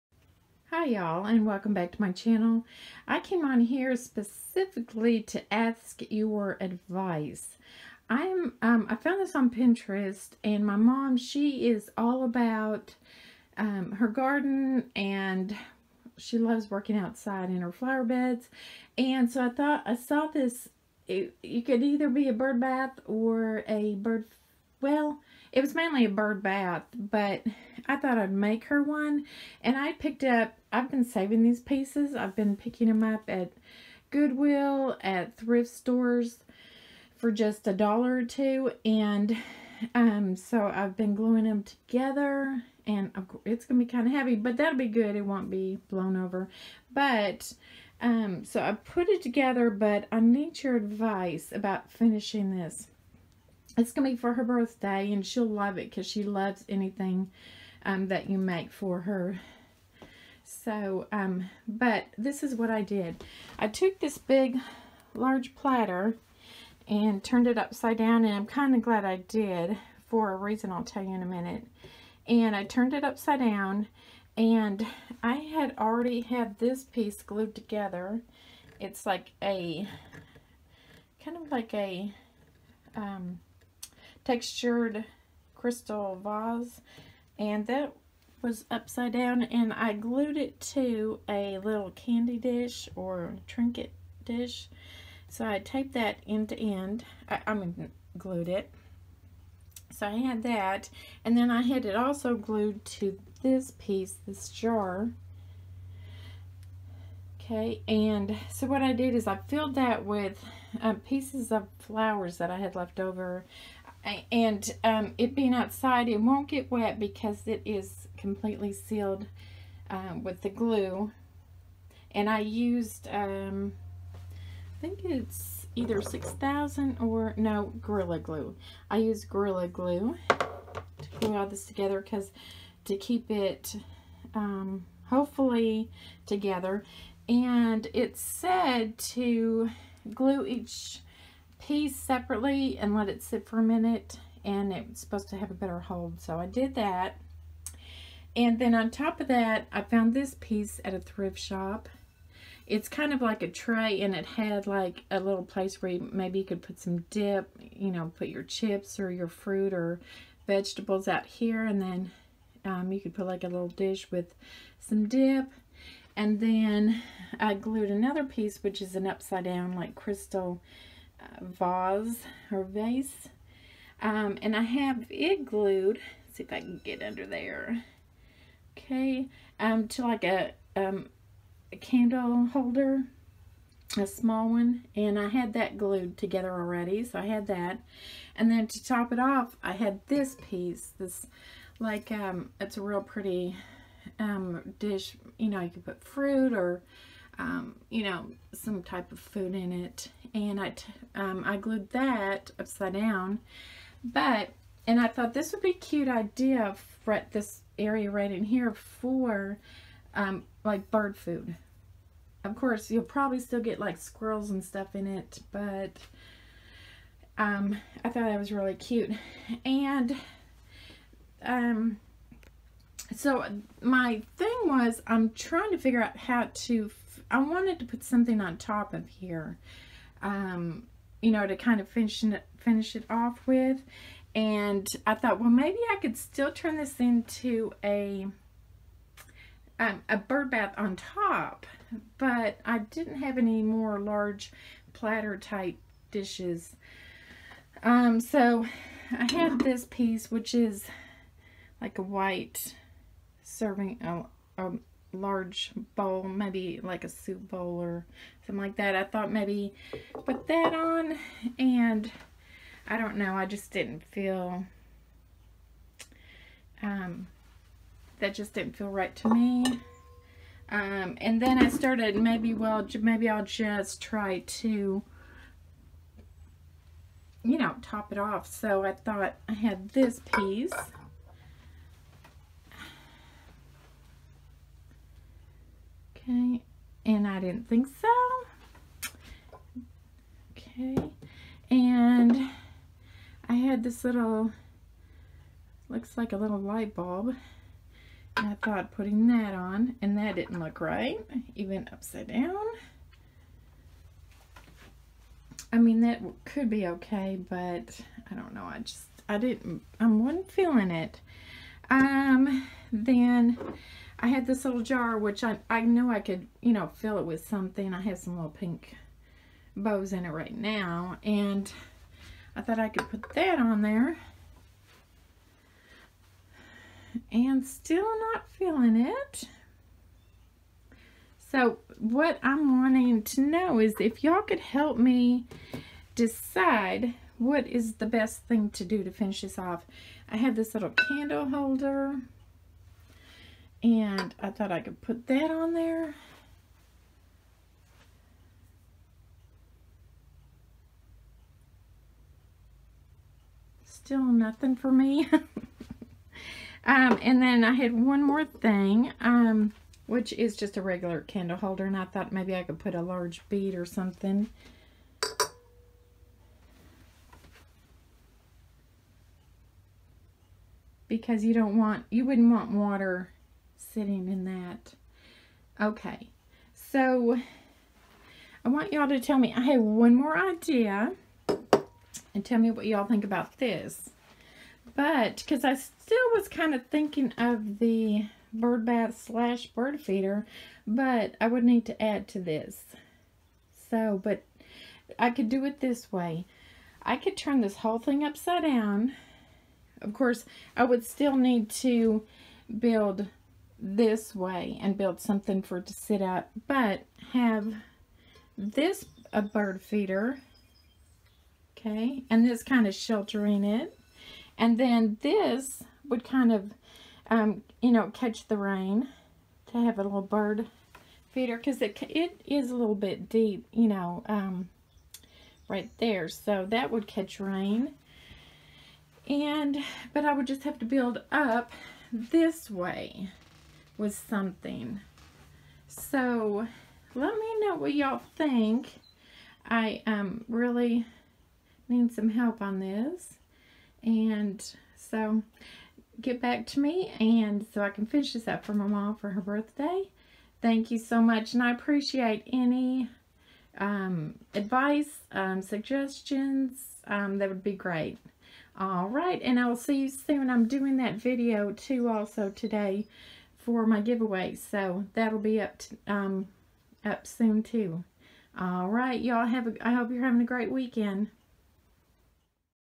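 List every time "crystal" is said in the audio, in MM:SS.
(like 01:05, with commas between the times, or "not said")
01:25, 02:49.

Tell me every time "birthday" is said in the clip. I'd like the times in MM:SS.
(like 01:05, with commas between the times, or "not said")
00:54, 07:29.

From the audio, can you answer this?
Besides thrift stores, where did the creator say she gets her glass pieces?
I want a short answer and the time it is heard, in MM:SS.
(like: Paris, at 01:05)
Goodwill, at 00:34.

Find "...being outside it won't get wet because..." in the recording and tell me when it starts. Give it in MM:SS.
01:55.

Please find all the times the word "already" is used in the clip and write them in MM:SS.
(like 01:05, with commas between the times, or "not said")
01:15, 03:06.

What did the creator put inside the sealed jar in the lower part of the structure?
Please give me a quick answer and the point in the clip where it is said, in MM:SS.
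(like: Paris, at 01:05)
Pieces of flowers, at 01:51.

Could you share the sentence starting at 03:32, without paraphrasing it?
Of course, you'll probably still get like squirrels and stuff in it, but um, I thought that was really cute.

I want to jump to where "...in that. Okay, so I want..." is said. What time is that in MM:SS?
06:14.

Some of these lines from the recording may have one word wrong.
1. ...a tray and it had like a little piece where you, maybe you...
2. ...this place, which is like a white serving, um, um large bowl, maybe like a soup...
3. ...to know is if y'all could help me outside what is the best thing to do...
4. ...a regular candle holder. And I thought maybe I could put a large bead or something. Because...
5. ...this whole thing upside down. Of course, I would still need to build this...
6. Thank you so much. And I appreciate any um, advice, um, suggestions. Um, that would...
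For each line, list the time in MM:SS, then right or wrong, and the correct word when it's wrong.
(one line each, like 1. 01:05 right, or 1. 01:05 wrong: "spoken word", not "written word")
1. 02:33 wrong: "place", not "piece"
2. 04:09 wrong: "piece", not "place"
3. 05:33 wrong: "decide", not "outside"
4. 06:00 right
5. 06:37 right
6. 07:30 right.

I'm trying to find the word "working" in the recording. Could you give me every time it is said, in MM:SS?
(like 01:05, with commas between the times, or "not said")
00:16.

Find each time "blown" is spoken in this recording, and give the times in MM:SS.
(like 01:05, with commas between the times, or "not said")
00:45.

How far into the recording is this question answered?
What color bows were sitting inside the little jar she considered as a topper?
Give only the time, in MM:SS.
05:18.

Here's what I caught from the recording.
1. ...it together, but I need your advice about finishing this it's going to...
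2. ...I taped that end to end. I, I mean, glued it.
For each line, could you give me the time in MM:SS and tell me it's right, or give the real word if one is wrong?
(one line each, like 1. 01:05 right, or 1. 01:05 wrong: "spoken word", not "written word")
1. 00:49 right
2. 01:35 right.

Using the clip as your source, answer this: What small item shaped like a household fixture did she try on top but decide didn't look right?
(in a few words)
A little light bulb.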